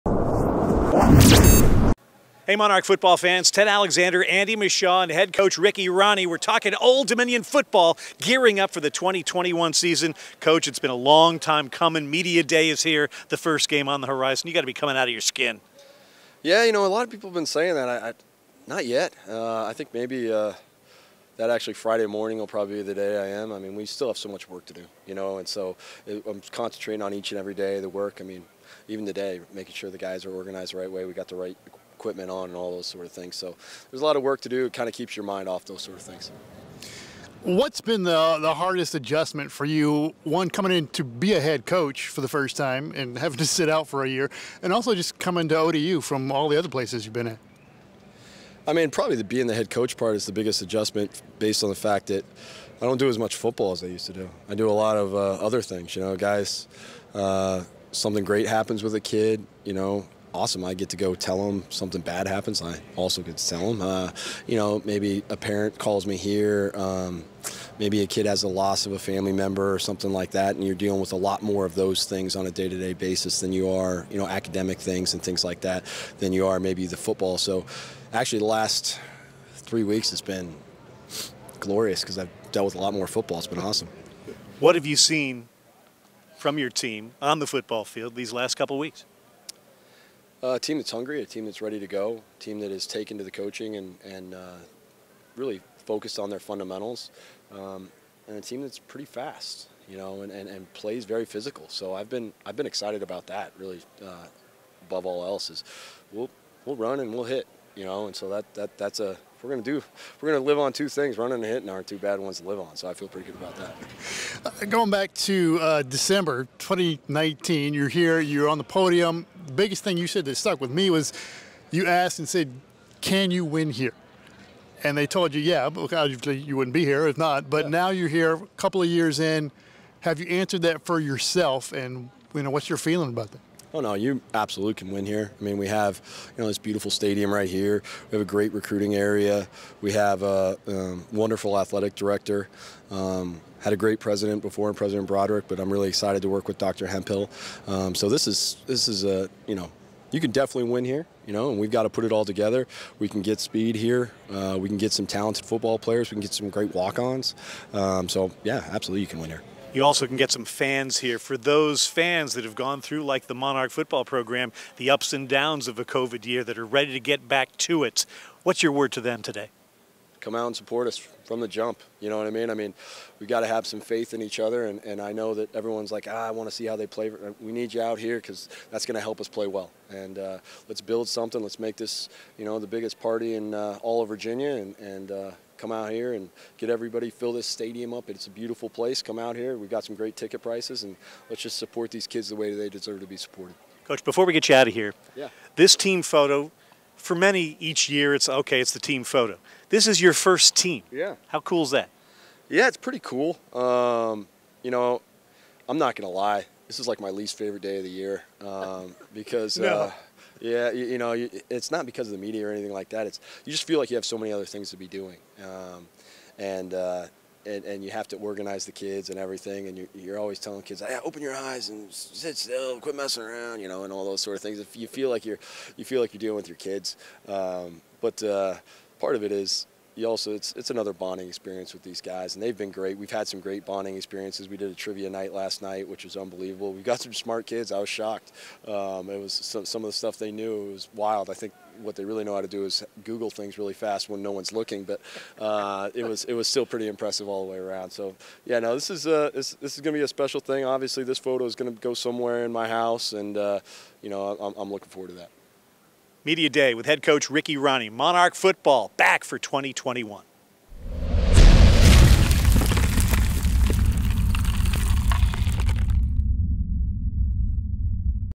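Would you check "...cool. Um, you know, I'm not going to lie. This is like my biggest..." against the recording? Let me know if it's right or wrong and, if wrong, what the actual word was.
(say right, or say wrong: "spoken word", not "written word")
wrong: "least", not "biggest".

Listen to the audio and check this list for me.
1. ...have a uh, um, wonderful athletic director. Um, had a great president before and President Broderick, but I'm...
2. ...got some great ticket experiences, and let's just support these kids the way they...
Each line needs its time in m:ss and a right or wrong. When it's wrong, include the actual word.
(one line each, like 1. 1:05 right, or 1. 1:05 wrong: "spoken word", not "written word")
1. 2:19 right
2. 3:09 wrong: "prices", not "experiences".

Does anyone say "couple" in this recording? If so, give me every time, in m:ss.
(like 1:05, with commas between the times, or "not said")
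1:28, 2:08.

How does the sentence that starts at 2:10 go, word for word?
Have you answered that for yourself?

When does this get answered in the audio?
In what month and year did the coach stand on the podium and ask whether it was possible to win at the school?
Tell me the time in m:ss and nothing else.
1:55.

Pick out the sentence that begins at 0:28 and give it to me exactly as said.
I mean, even today, making sure the guys are organized the right way.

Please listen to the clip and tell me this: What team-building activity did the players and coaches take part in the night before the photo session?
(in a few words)
Trivia night.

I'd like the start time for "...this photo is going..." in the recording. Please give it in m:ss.
4:11.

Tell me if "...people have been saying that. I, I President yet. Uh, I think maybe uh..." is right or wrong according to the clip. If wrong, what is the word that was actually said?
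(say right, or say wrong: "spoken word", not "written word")
wrong: "Not", not "President".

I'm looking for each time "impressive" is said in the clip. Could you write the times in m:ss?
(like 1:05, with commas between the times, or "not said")
4:06.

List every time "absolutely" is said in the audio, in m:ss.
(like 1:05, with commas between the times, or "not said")
2:14, 2:38.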